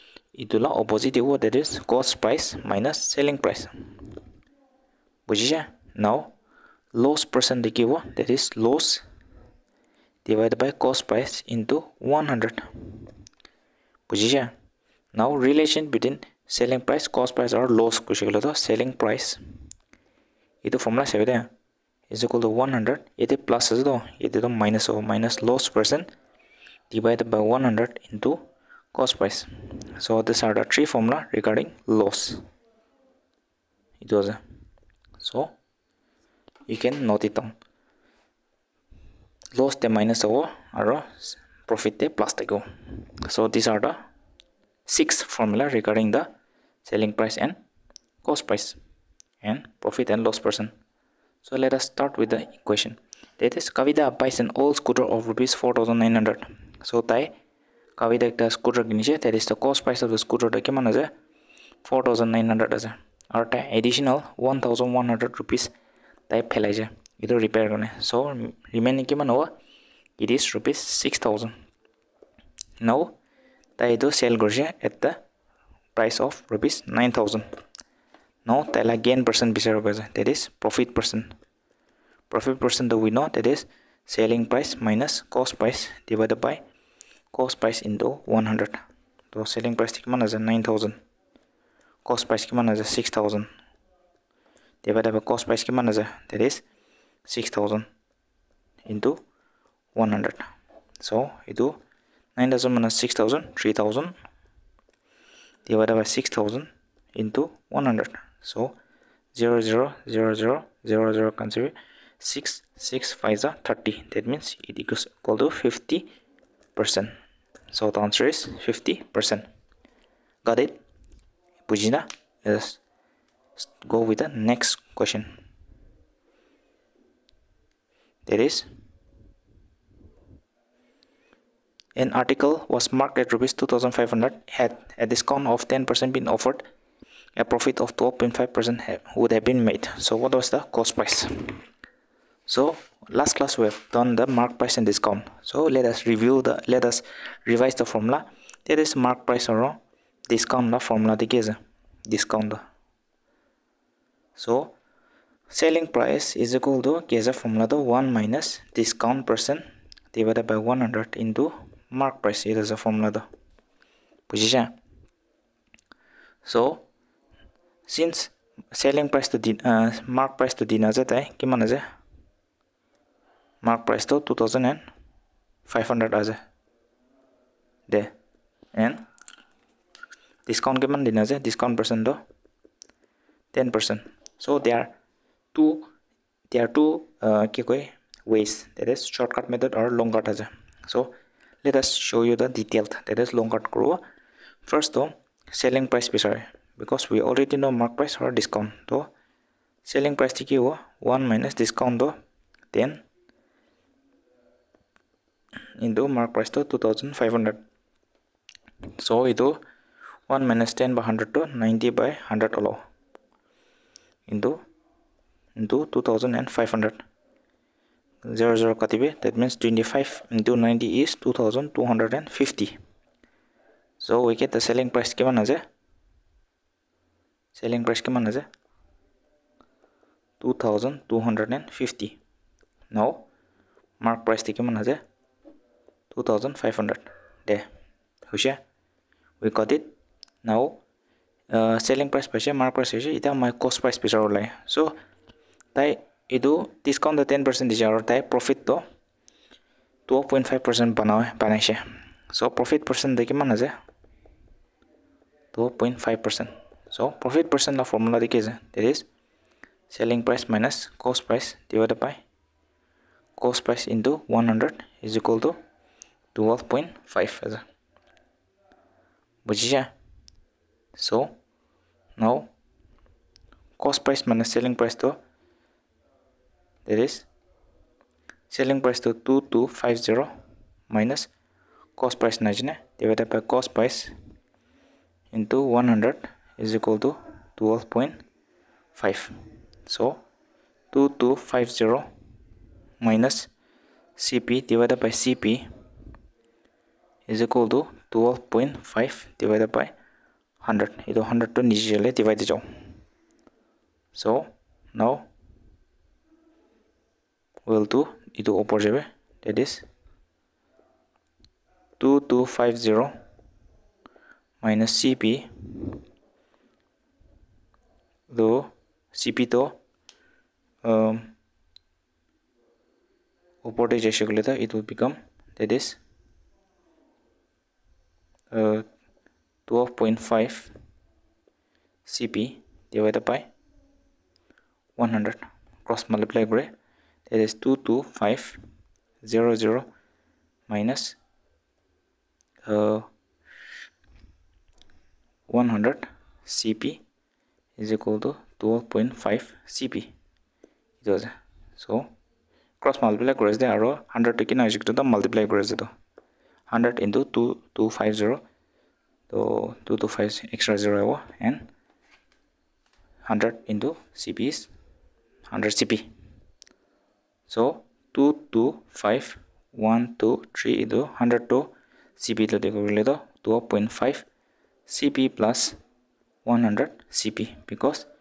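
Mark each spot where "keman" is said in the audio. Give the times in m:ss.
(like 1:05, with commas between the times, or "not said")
1:00, 1:09.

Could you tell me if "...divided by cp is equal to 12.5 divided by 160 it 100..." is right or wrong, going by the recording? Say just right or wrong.
wrong.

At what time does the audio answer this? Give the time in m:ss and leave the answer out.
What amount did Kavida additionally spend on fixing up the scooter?
1:04.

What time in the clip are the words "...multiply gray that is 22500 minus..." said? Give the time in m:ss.
5:36.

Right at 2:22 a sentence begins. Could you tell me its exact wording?
So last class we have done the mark price and discount.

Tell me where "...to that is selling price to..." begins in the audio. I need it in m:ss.
4:35.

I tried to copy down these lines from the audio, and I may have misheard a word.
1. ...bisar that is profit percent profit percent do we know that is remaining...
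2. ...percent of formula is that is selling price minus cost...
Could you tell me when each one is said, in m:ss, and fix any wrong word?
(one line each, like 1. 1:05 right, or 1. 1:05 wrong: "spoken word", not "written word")
1. 1:19 wrong: "selling", not "remaining"
2. 4:17 right.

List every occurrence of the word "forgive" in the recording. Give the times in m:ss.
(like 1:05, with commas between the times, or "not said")
not said.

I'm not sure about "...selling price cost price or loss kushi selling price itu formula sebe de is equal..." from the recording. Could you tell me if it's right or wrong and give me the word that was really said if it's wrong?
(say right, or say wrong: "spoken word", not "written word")
right.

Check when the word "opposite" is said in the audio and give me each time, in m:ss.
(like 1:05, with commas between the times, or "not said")
0:00, 5:08.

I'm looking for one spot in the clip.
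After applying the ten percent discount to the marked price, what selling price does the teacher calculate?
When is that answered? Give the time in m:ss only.
3:41.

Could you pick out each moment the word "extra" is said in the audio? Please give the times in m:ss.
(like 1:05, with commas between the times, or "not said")
6:00.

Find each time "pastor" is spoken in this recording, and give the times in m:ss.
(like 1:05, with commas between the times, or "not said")
not said.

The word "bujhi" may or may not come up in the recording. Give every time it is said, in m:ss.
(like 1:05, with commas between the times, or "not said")
0:05, 0:14.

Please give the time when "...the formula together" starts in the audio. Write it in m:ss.
2:30.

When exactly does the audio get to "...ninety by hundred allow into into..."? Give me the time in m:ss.
3:31.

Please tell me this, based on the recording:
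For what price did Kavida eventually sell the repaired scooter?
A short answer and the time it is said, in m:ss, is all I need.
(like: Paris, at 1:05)
9000 rupees, at 1:16.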